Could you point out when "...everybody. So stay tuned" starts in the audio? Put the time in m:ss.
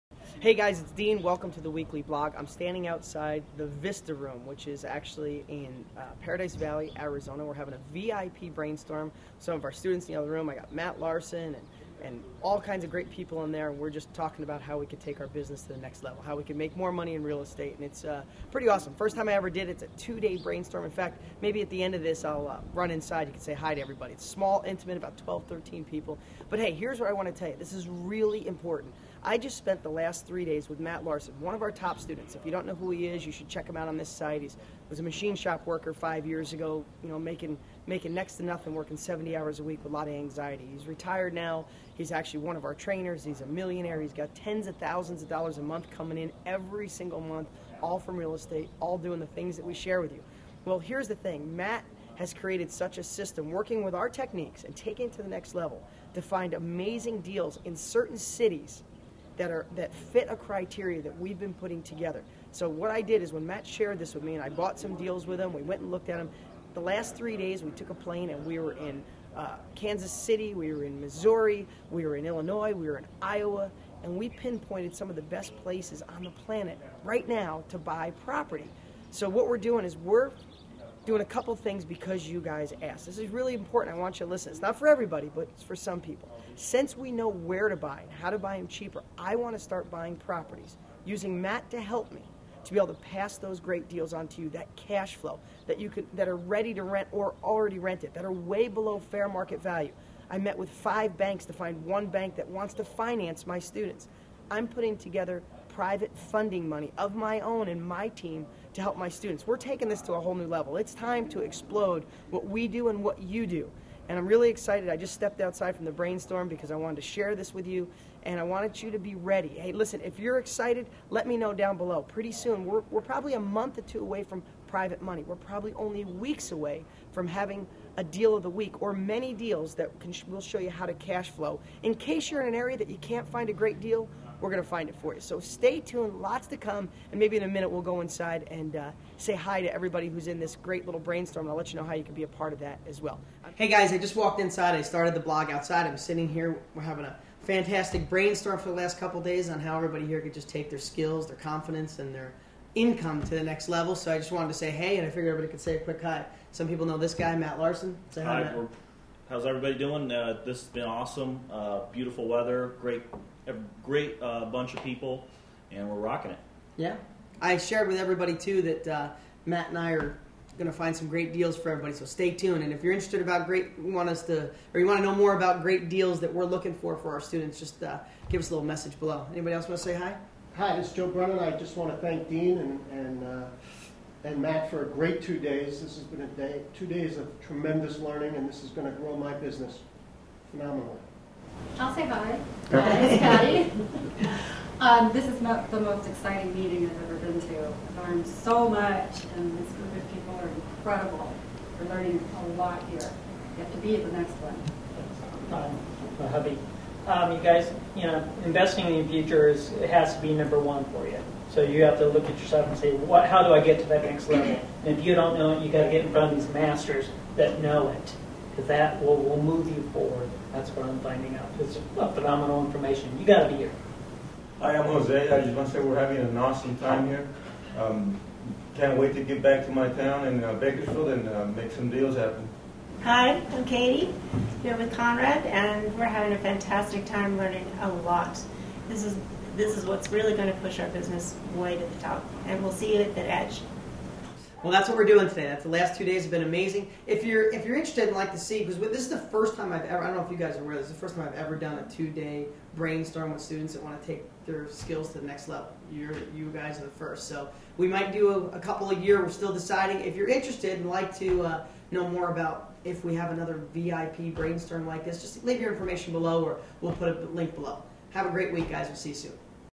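2:51.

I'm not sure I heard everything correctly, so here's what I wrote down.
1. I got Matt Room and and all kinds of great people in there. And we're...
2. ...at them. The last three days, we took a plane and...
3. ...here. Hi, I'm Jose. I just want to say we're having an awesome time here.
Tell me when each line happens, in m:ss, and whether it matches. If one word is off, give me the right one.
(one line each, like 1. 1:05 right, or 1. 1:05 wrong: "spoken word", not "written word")
1. 0:10 wrong: "Larson", not "Room"
2. 1:06 right
3. 3:43 right.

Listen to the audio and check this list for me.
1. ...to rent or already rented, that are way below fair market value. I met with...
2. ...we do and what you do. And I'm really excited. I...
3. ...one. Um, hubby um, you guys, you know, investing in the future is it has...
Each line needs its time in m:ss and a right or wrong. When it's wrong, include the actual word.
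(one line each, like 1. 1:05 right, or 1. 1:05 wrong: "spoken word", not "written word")
1. 1:36 right
2. 1:52 right
3. 3:24 right.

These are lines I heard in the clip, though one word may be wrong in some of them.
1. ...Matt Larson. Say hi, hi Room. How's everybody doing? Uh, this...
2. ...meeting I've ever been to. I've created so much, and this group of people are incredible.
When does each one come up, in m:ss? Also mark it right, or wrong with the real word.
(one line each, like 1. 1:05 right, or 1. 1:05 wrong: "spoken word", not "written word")
1. 2:37 wrong: "Matt", not "Room"
2. 3:16 wrong: "learned", not "created".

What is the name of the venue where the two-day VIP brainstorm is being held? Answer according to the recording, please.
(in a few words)
Vista Room.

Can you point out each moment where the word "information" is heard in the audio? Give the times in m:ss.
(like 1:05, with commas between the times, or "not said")
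3:42, 4:25.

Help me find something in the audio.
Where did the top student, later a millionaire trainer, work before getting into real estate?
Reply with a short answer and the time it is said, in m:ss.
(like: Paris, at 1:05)
Machine shop, at 0:35.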